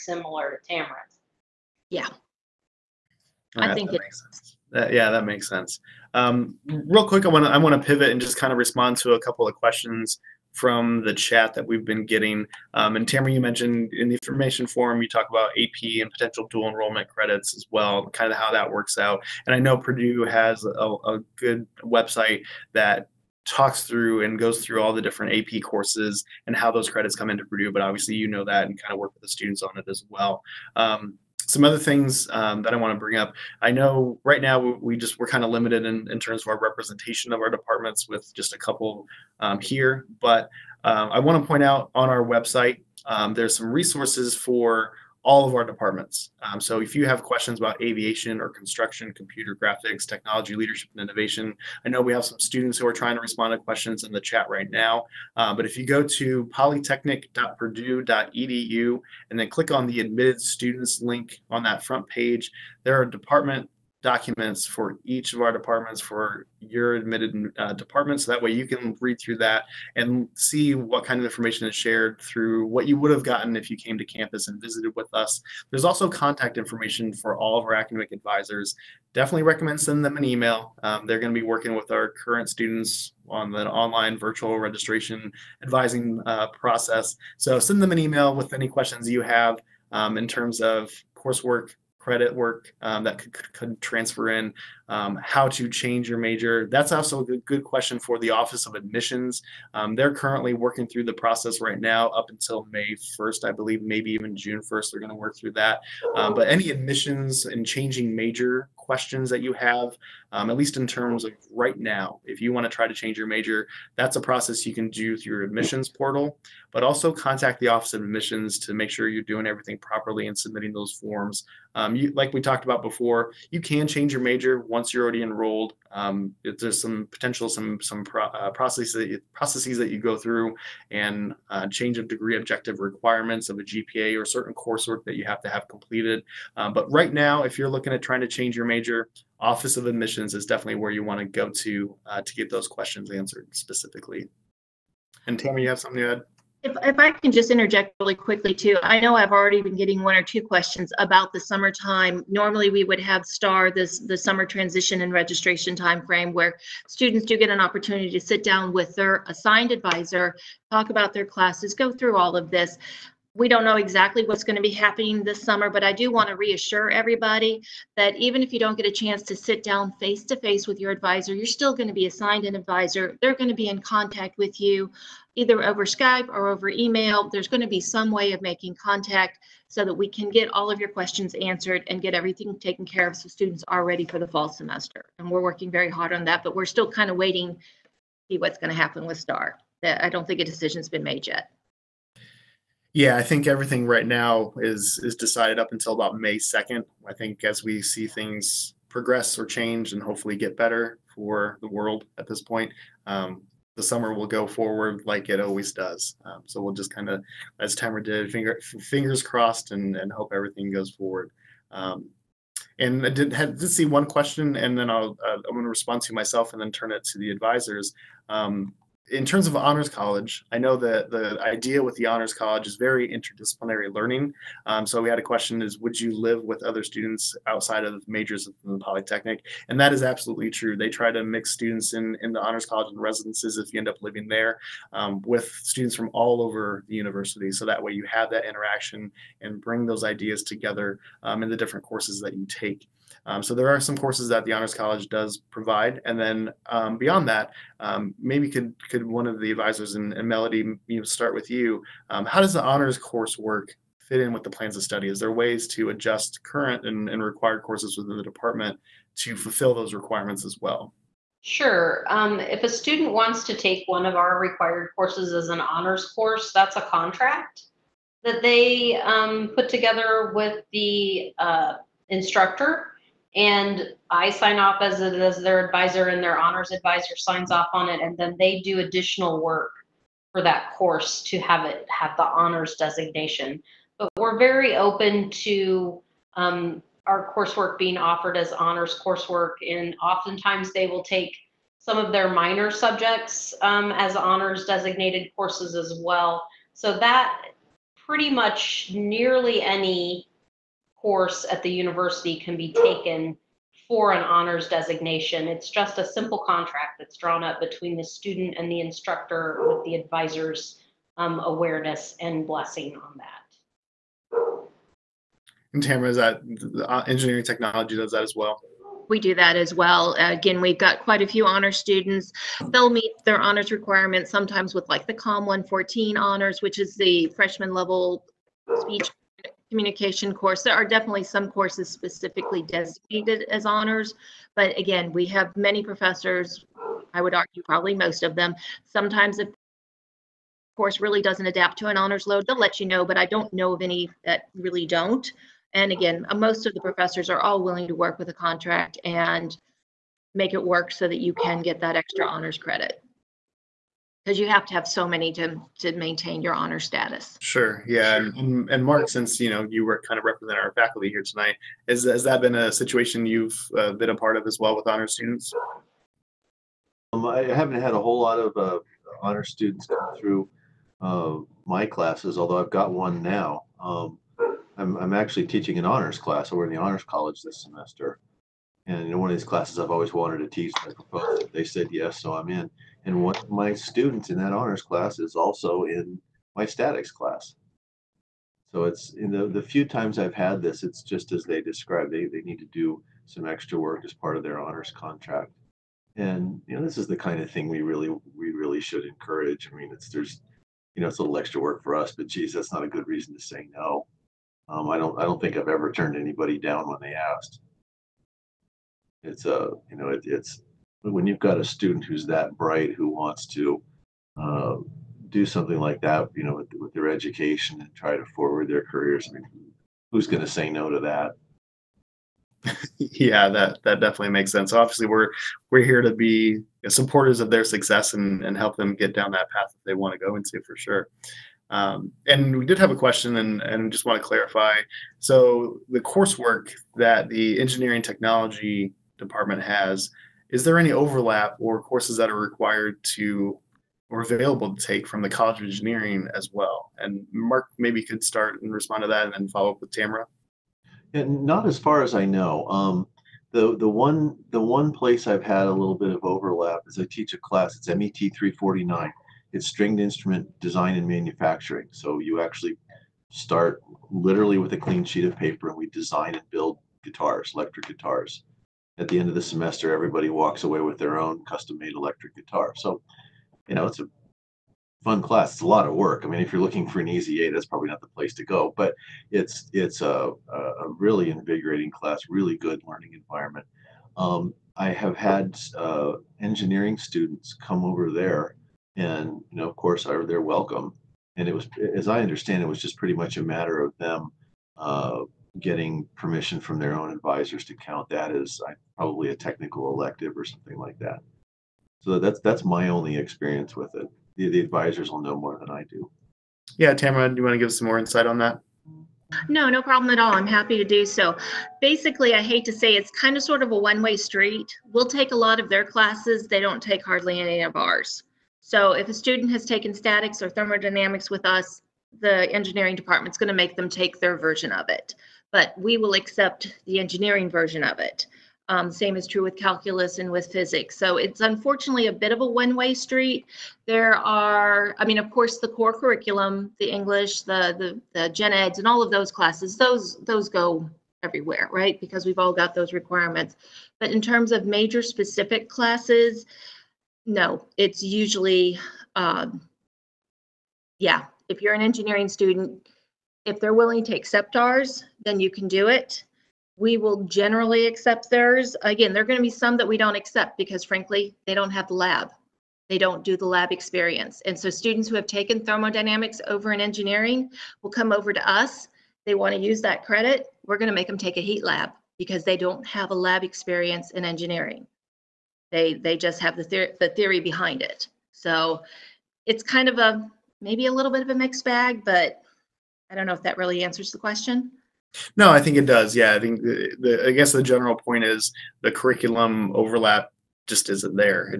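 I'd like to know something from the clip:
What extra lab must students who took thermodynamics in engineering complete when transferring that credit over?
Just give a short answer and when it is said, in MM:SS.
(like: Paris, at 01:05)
heat lab, at 09:31.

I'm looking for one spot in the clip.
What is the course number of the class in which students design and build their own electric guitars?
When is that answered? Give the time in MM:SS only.
07:37.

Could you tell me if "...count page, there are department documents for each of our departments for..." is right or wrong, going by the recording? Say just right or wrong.
wrong.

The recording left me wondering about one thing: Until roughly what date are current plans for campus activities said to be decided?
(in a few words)
May 2nd.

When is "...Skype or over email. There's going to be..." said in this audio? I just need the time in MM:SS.
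02:55.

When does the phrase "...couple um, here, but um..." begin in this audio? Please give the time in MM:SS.
00:38.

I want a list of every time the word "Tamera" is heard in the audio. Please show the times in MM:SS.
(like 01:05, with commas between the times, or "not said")
00:00, 00:13, 05:15, 07:29, 08:26.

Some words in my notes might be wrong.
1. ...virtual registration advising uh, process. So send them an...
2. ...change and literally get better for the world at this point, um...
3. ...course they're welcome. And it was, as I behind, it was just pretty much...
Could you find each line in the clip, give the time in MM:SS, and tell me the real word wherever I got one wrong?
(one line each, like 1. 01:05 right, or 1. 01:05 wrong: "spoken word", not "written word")
1. 01:24 right
2. 03:19 wrong: "hopefully", not "literally"
3. 08:09 wrong: "understand", not "behind".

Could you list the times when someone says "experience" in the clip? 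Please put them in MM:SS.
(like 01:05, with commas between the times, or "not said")
08:23, 09:23, 09:33.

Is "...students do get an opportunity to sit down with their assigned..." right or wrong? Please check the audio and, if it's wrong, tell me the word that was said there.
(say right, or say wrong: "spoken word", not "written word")
right.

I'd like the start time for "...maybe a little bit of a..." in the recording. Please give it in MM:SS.
09:40.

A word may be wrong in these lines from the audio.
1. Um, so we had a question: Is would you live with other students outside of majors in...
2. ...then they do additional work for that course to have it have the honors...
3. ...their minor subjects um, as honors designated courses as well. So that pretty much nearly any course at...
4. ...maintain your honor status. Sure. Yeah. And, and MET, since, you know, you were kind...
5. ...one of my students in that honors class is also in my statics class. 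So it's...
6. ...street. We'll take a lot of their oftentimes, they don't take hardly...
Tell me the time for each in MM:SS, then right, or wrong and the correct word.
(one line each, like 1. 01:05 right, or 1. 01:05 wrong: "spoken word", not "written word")
1. 03:44 right
2. 04:38 right
3. 04:52 right
4. 05:55 wrong: "Mark", not "MET"
5. 06:23 right
6. 08:34 wrong: "classes", not "oftentimes".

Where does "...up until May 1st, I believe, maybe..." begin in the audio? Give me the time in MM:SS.
01:42.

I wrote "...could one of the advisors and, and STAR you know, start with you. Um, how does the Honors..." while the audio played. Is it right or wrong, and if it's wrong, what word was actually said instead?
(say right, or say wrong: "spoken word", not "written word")
wrong: "Melody", not "STAR".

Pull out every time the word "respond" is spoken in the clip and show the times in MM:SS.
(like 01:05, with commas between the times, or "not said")
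00:08, 00:53, 03:35, 07:28.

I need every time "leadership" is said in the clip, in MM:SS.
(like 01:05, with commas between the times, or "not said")
00:50.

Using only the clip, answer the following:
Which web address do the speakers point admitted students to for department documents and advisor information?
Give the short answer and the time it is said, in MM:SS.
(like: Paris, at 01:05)
polytechnic.purdue.edu, at 00:56.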